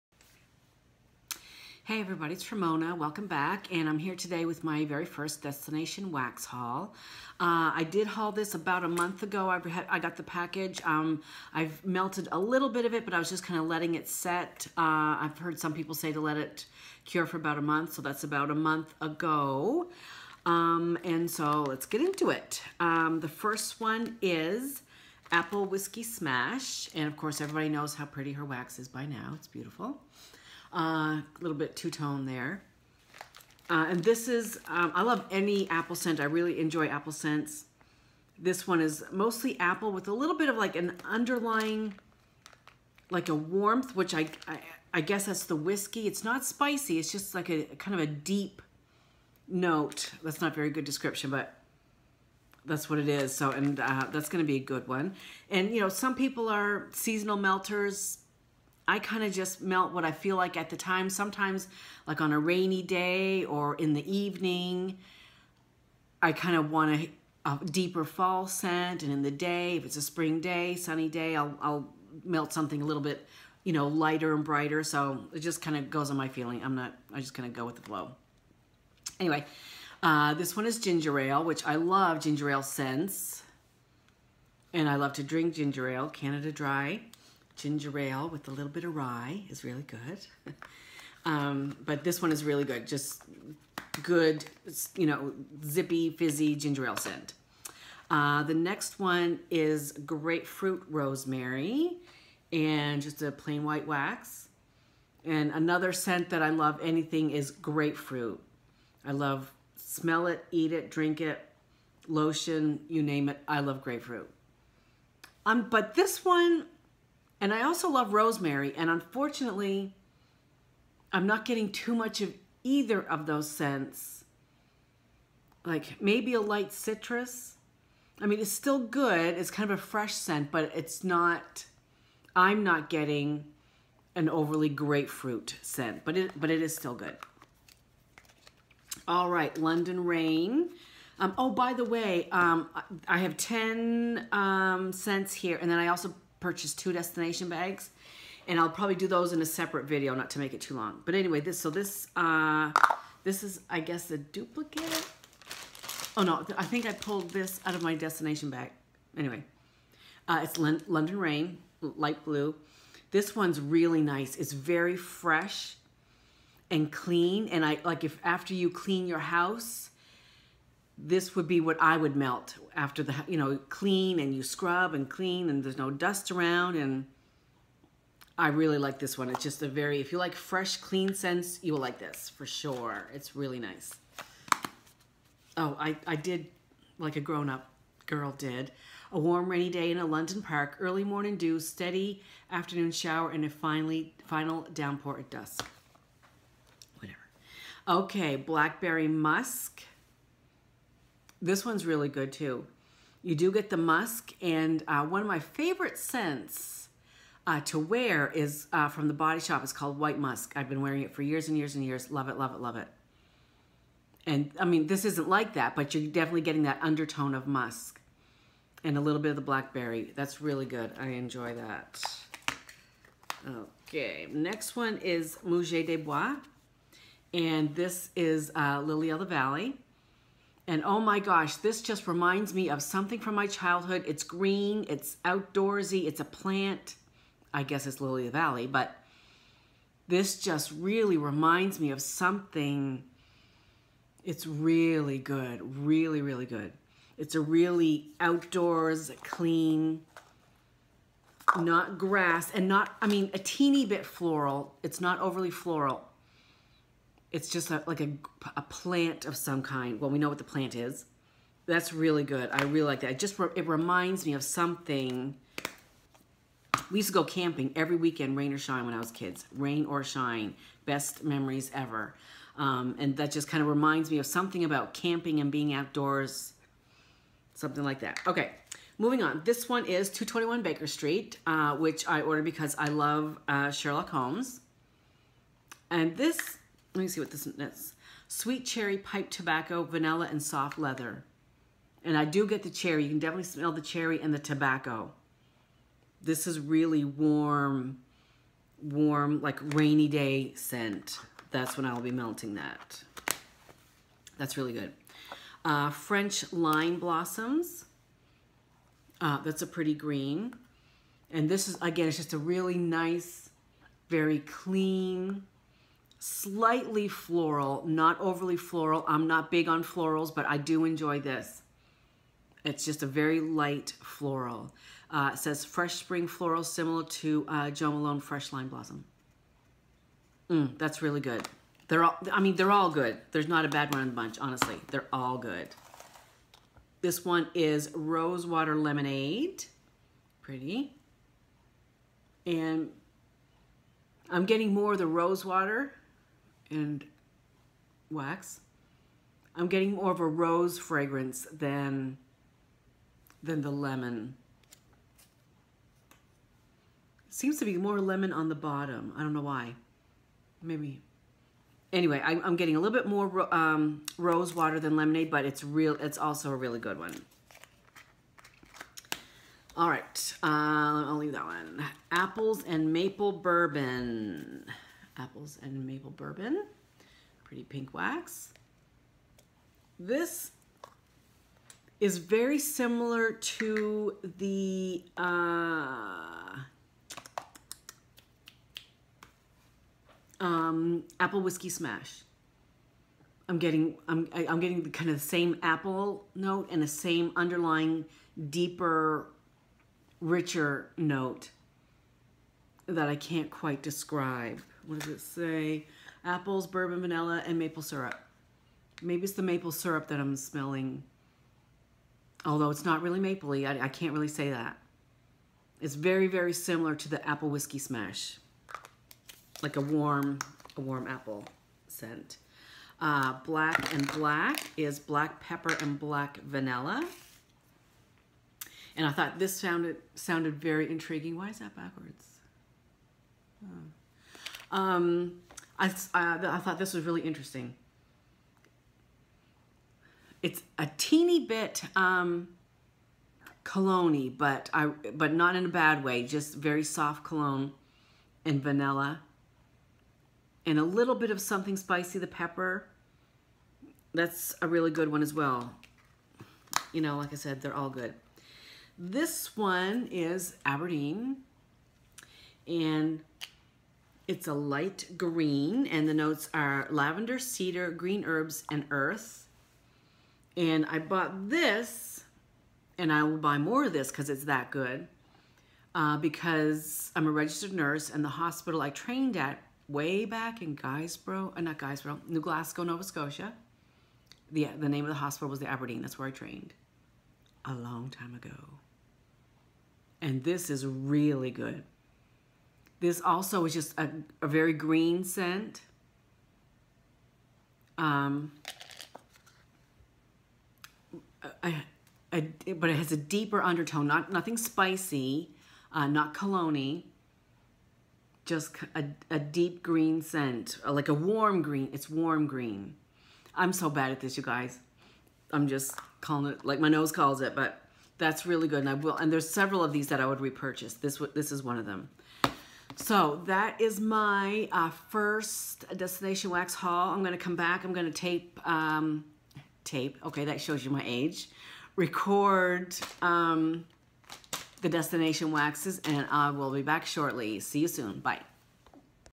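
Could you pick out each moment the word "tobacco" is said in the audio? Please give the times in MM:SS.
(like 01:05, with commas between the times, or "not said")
04:49, 04:54.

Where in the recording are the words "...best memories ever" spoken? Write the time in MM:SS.
04:30.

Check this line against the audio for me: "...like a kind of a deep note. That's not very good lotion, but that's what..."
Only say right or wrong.
wrong.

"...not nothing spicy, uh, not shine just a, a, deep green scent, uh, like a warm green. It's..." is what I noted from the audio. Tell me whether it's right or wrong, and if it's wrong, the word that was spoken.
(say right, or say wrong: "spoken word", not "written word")
wrong: "cologne", not "shine".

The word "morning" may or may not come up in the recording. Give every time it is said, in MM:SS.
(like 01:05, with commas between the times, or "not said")
03:11.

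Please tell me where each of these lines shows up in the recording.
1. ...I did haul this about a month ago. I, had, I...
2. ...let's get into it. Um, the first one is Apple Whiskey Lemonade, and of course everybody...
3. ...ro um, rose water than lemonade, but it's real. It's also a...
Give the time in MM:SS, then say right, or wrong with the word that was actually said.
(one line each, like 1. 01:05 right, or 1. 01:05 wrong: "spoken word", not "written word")
1. 00:07 right
2. 00:21 wrong: "Smash", not "Lemonade"
3. 06:03 right.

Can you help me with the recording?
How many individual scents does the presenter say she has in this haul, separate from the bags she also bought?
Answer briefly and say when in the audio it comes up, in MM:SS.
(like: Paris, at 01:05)
10, at 02:23.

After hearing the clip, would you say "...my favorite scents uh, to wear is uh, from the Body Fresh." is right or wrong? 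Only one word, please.
wrong.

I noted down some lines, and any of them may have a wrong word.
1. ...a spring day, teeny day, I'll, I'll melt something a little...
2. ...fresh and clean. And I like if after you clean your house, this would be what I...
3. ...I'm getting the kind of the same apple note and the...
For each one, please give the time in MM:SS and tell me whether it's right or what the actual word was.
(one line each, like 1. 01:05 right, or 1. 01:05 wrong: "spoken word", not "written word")
1. 01:09 wrong: "sunny", not "teeny"
2. 02:44 right
3. 06:34 right.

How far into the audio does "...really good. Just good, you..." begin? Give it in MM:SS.
01:32.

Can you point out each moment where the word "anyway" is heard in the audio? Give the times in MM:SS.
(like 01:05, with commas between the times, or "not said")
01:19, 02:31, 02:39, 06:01.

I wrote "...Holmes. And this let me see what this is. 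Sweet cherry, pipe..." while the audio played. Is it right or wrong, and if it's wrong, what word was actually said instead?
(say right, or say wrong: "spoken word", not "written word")
right.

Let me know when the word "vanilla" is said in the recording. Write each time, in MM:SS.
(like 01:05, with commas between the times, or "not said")
04:49, 06:47, 07:06, 07:28.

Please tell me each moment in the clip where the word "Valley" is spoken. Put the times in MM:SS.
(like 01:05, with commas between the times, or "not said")
03:49, 03:58.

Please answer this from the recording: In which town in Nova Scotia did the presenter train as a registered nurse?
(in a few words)
New Glasgow.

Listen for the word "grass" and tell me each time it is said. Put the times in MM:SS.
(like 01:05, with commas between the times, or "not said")
04:11.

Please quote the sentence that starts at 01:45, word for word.
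And another scent that I love anything is grapefruit.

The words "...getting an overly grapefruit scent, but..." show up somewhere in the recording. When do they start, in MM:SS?
02:12.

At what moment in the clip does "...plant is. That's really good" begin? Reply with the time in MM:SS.
04:20.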